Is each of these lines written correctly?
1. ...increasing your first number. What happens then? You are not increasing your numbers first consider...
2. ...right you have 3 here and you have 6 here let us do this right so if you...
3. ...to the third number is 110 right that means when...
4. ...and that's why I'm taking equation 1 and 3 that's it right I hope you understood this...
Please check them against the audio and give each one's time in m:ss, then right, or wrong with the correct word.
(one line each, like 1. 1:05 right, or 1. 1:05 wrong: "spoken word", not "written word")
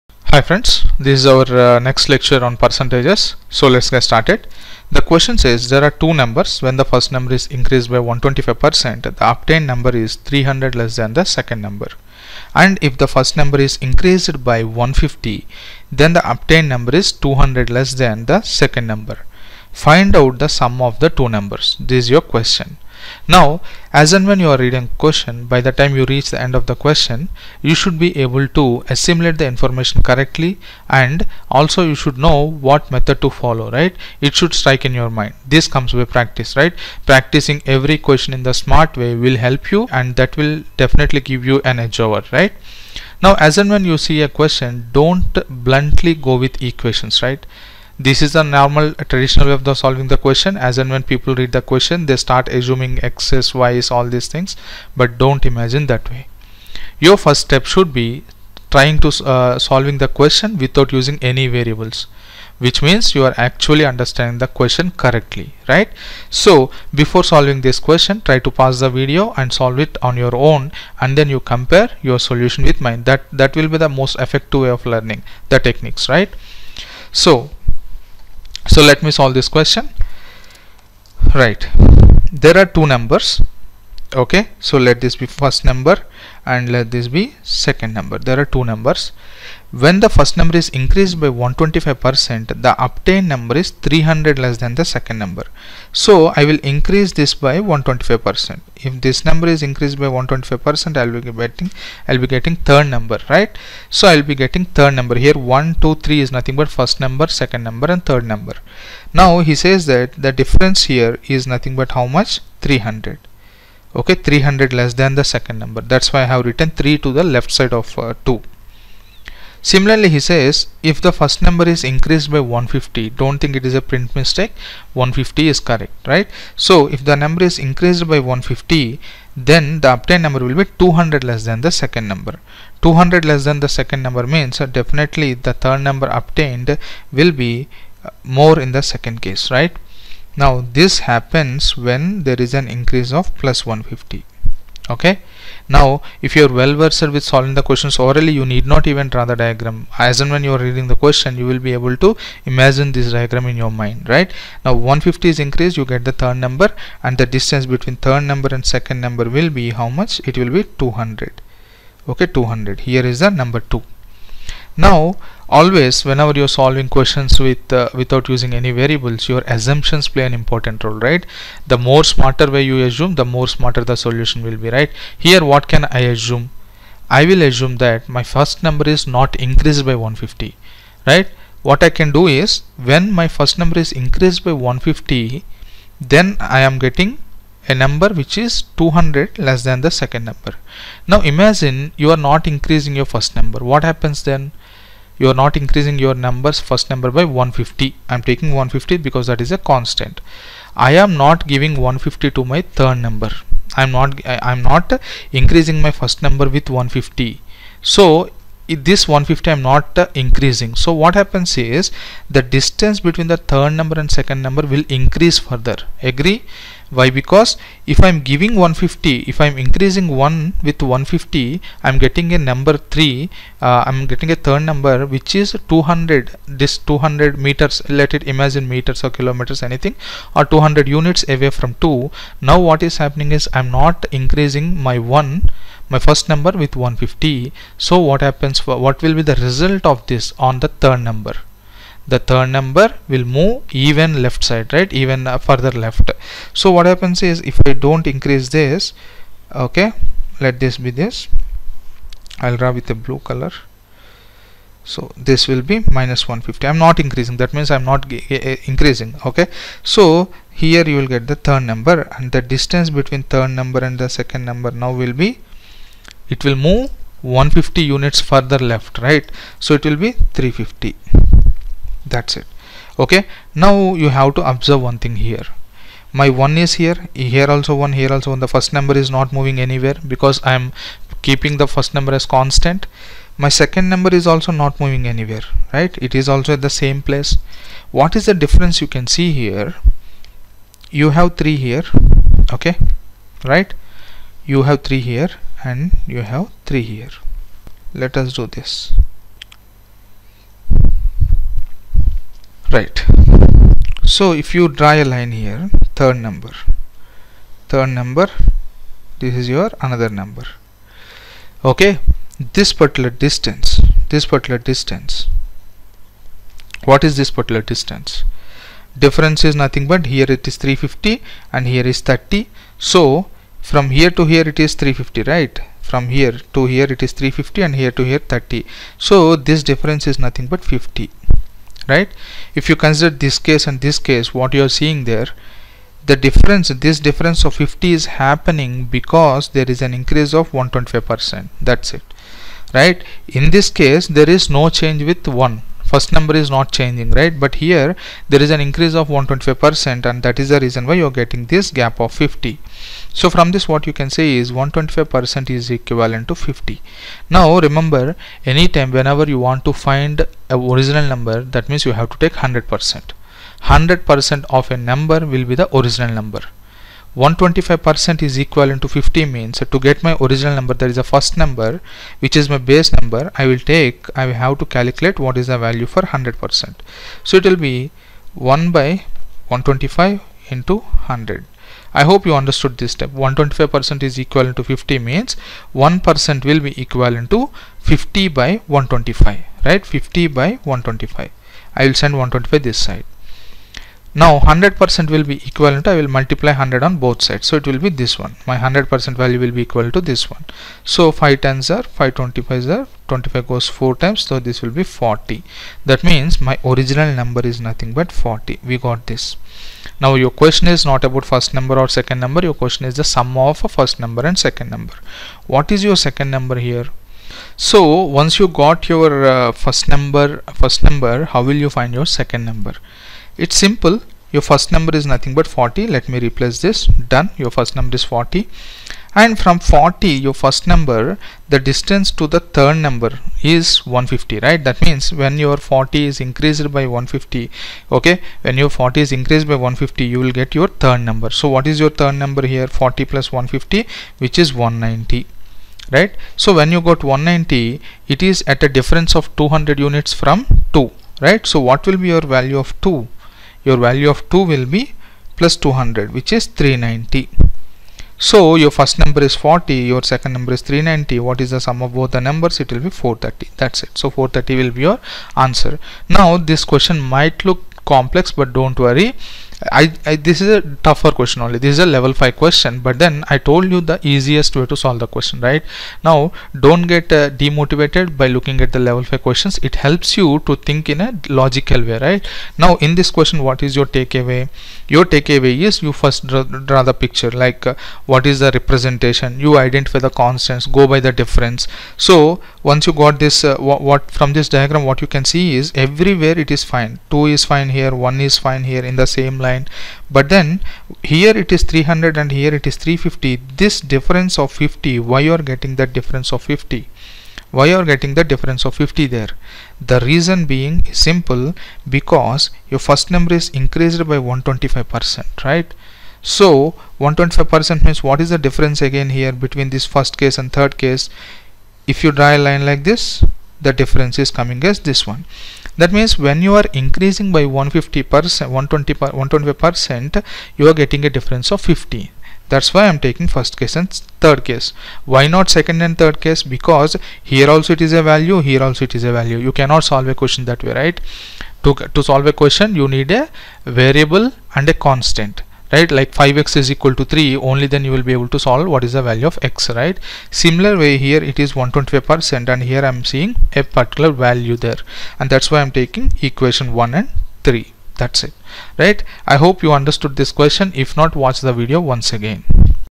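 1. 3:12 wrong: "number", not "consider"
2. 4:53 wrong: "3", not "6"
3. 7:12 wrong: "150", not "110"
4. 9:15 right.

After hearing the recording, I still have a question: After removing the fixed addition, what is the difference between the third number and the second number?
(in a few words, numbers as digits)
350.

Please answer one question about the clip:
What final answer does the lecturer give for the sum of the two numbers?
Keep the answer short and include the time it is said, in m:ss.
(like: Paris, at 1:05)
430, at 7:42.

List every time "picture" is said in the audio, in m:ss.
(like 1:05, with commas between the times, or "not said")
8:06.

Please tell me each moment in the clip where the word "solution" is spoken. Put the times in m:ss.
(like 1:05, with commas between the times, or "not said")
1:12, 2:53.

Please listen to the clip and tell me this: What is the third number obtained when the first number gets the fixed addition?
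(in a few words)
190.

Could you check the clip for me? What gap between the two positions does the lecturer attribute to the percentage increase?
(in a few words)
50.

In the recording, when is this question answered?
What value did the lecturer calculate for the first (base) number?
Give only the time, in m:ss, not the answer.
6:44.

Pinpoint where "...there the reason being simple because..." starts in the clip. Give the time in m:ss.
8:29.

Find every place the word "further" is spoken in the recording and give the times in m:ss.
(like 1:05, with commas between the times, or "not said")
3:35, 4:05, 4:28.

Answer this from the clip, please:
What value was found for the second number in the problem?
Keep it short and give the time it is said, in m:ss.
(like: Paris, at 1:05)
390, at 7:36.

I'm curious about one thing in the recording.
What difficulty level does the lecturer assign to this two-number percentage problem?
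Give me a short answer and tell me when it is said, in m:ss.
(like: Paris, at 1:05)
level 5, at 7:51.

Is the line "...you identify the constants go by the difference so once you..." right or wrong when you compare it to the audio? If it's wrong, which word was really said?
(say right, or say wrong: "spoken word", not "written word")
right.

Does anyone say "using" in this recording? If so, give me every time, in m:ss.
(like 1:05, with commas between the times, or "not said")
1:00, 2:48.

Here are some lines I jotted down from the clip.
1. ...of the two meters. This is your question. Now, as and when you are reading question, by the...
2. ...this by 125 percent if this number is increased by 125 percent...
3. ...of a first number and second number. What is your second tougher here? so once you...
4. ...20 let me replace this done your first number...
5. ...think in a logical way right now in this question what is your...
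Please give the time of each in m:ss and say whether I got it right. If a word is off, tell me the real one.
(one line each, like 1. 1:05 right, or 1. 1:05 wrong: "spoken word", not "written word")
1. 0:20 wrong: "numbers", not "meters"
2. 1:37 right
3. 6:53 wrong: "number", not "tougher"
4. 7:05 wrong: "40", not "20"
5. 8:00 right.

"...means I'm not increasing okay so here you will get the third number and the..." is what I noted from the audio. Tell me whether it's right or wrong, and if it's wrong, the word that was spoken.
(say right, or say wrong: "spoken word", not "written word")
right.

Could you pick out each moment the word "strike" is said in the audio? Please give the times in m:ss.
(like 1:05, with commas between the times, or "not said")
0:34.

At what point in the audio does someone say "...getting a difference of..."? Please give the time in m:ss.
8:50.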